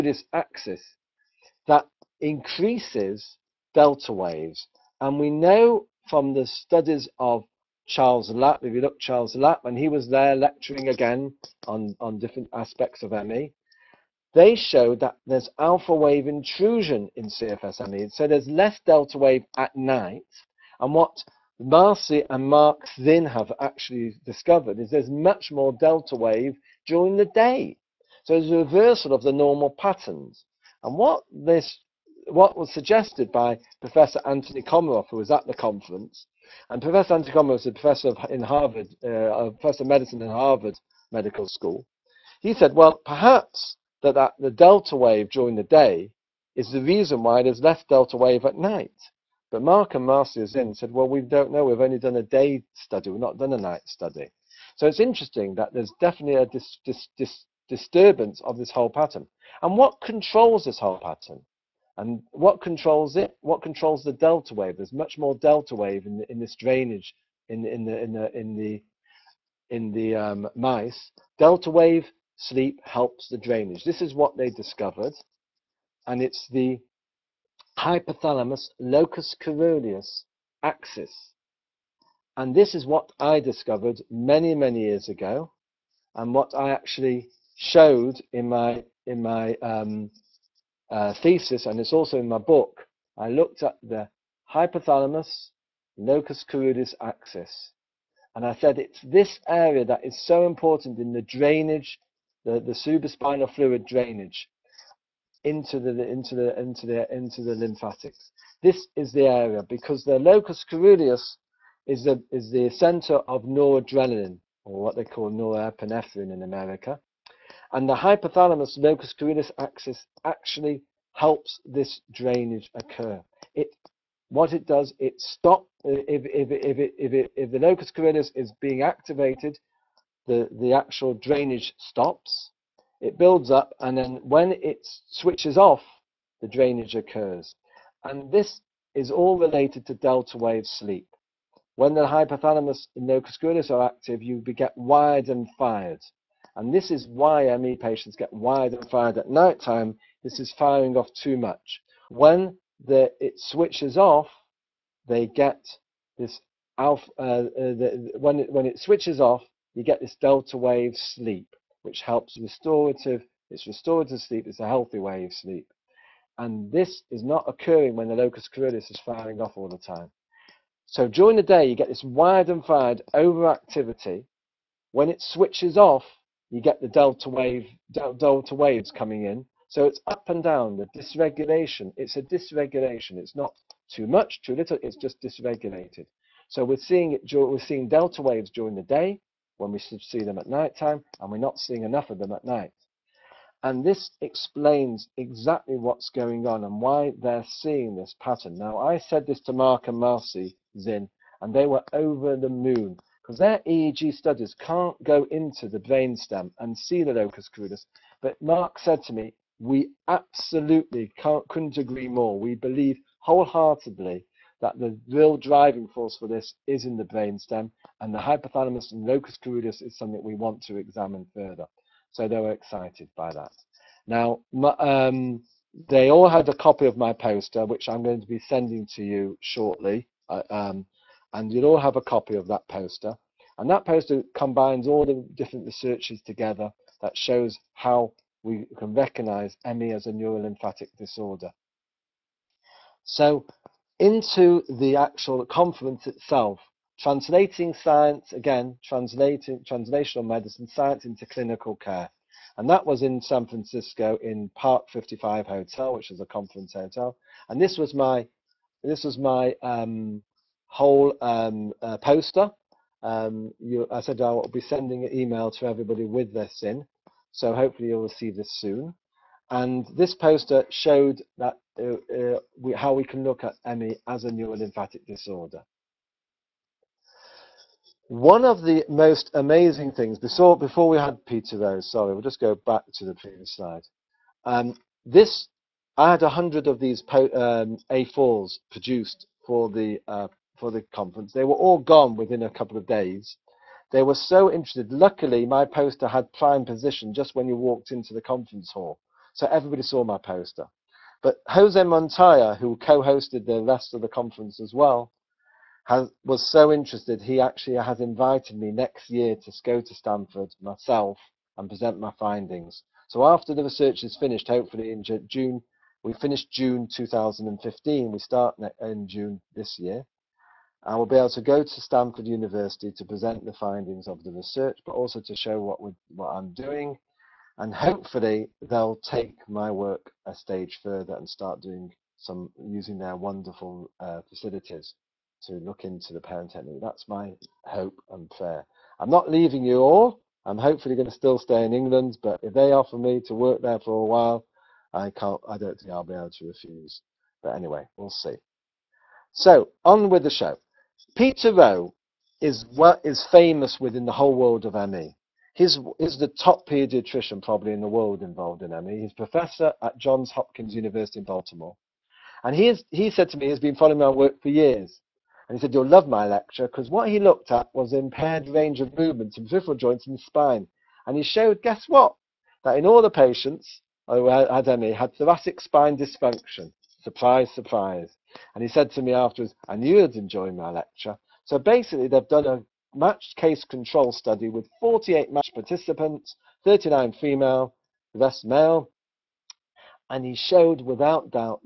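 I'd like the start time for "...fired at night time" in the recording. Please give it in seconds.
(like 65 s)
148 s.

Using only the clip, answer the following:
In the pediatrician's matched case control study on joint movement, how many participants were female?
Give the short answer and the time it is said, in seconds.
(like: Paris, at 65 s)
39, at 386 s.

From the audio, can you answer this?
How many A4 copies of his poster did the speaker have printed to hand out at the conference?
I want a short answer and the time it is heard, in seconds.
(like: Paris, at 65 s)
100, at 286 s.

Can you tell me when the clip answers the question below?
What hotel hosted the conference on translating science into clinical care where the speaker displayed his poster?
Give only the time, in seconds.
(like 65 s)
254 s.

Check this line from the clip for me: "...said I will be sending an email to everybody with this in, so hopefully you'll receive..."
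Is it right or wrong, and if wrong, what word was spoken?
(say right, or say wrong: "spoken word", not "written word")
right.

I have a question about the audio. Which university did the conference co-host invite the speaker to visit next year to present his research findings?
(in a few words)
Stanford University.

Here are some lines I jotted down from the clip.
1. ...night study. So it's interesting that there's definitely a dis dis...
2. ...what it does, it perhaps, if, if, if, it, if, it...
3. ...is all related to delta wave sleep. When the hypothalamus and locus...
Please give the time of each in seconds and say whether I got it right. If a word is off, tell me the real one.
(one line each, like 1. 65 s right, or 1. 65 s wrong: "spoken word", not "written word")
1. 53 s right
2. 124 s wrong: "stops", not "perhaps"
3. 138 s right.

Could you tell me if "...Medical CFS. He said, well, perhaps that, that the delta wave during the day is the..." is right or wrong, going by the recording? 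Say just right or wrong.
wrong.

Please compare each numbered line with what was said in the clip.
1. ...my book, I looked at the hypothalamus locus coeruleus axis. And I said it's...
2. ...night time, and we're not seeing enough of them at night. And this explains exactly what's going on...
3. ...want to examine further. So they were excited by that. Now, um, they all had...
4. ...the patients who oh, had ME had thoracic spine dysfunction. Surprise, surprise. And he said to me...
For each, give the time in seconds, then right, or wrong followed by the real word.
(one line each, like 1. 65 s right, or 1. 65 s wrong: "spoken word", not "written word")
1. 92 s right
2. 190 s right
3. 220 s right
4. 373 s right.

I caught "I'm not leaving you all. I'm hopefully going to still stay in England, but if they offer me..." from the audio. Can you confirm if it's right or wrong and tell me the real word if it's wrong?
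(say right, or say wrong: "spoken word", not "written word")
right.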